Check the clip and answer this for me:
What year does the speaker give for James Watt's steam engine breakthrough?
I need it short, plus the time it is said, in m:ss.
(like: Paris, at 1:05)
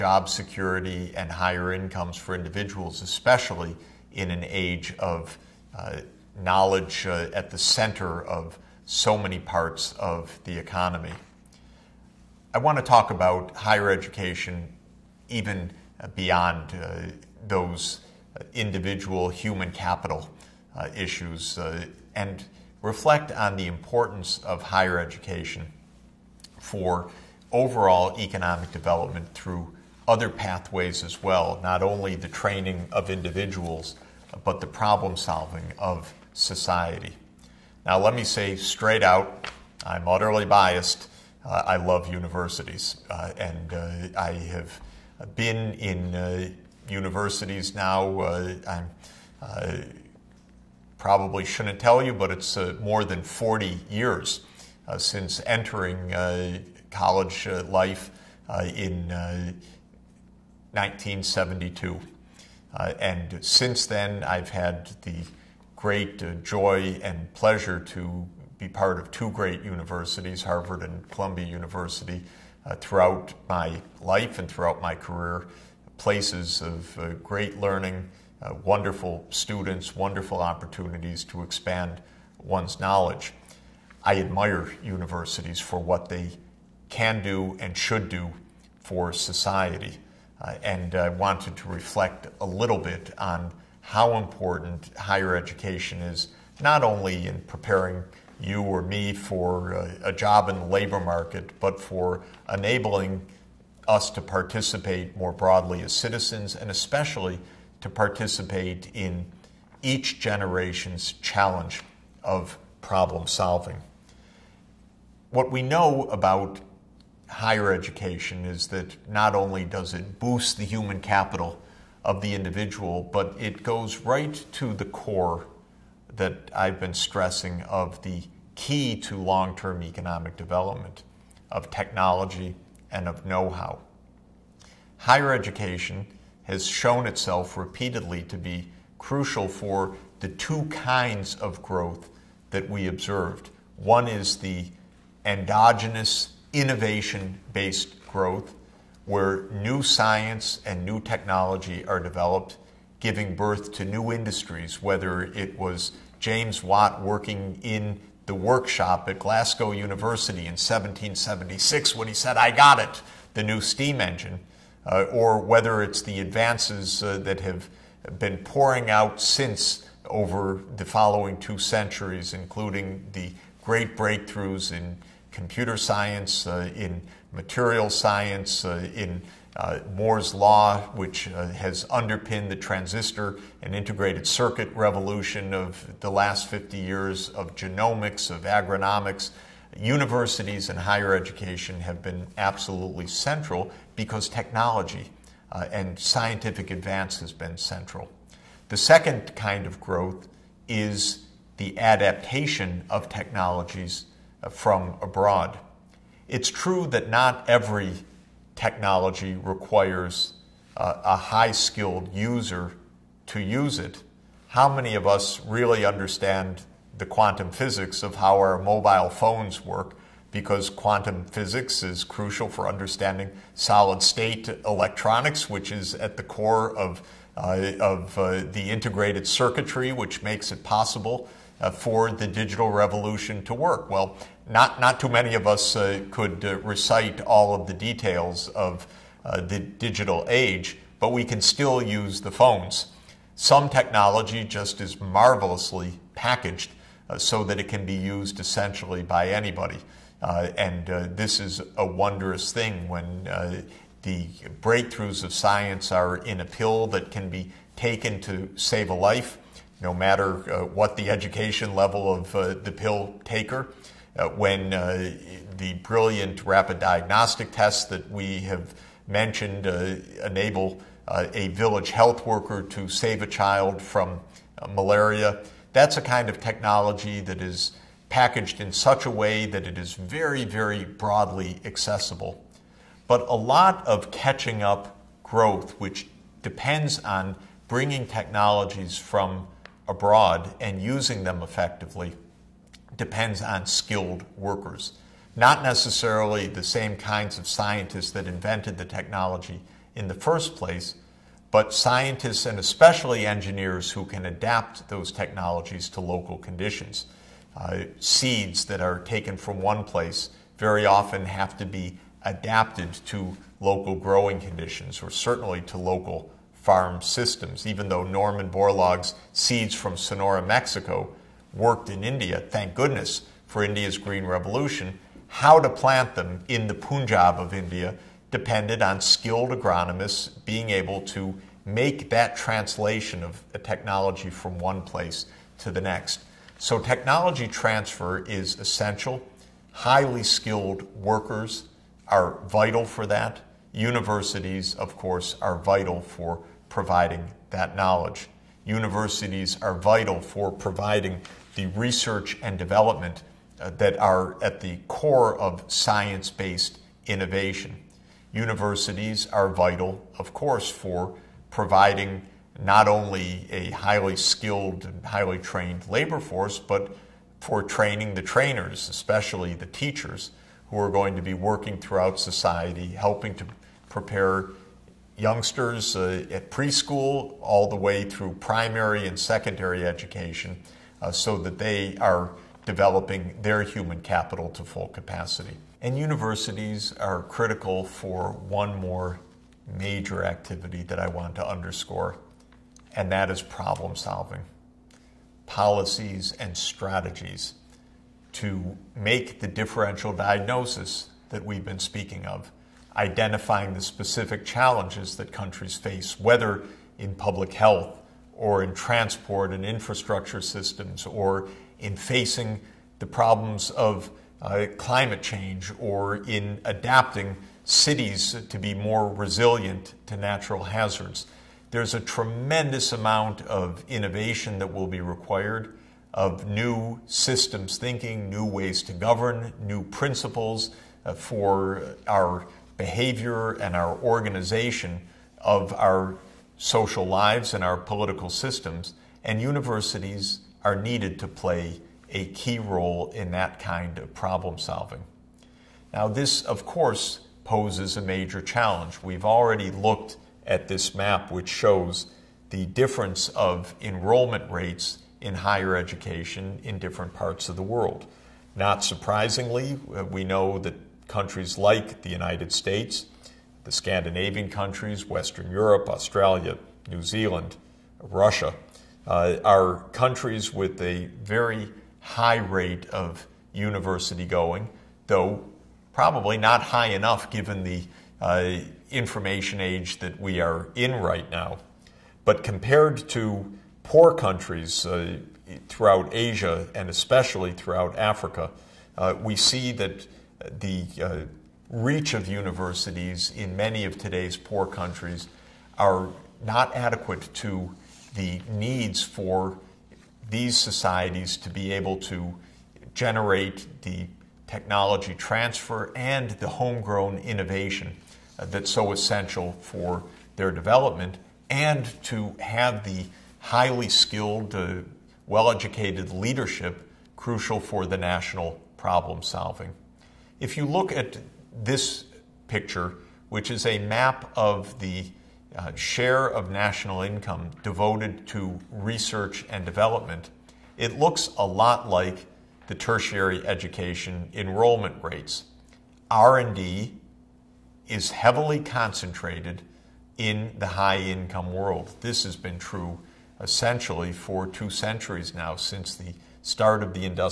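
1776, at 2:40.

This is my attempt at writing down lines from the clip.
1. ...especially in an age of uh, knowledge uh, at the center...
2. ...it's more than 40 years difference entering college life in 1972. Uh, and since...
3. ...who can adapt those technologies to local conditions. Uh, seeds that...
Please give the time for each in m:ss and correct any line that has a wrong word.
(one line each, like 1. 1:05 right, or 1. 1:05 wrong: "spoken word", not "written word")
1. 0:03 right
2. 0:52 wrong: "since", not "difference"
3. 5:03 right.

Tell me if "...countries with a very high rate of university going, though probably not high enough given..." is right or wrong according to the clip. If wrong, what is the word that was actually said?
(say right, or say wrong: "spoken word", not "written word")
right.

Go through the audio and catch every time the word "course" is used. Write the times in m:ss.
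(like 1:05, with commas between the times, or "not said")
5:44, 6:00, 7:26.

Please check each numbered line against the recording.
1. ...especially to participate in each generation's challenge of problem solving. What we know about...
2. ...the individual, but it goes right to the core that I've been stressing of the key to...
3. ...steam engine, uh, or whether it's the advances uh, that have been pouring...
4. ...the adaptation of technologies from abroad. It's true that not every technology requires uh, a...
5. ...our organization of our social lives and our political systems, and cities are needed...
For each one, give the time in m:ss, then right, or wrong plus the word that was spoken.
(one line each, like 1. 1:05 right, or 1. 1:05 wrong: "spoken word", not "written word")
1. 1:46 right
2. 2:02 right
3. 2:43 right
4. 3:21 right
5. 7:13 wrong: "universities", not "cities".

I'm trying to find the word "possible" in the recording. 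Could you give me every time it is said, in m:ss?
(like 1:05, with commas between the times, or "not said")
3:50.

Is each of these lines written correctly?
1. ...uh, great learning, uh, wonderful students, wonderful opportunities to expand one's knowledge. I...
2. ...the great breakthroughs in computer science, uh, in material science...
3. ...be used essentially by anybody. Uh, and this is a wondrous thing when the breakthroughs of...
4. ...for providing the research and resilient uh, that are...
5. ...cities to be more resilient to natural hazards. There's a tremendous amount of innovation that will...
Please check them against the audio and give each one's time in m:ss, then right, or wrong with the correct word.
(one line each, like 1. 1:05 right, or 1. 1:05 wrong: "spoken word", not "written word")
1. 1:16 right
2. 2:53 right
3. 4:07 right
4. 5:50 wrong: "development", not "resilient"
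5. 6:57 right.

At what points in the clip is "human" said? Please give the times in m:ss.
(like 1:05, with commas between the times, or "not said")
0:19, 2:00, 6:23.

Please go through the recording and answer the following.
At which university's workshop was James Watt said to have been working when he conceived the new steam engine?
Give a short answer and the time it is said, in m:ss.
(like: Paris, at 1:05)
Glasgow University, at 2:39.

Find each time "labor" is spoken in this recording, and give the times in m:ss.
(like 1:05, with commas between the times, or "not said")
1:40, 6:05.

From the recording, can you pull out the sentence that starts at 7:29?
We've already looked at this map, which shows the difference of enrollment rates in higher education in different parts of the world.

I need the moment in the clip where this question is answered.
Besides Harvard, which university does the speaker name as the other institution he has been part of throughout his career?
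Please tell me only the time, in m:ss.
1:11.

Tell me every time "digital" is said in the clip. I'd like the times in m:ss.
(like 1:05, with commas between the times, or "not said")
3:52, 3:59.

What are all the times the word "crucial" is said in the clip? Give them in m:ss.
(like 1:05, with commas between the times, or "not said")
2:18, 3:42, 8:37.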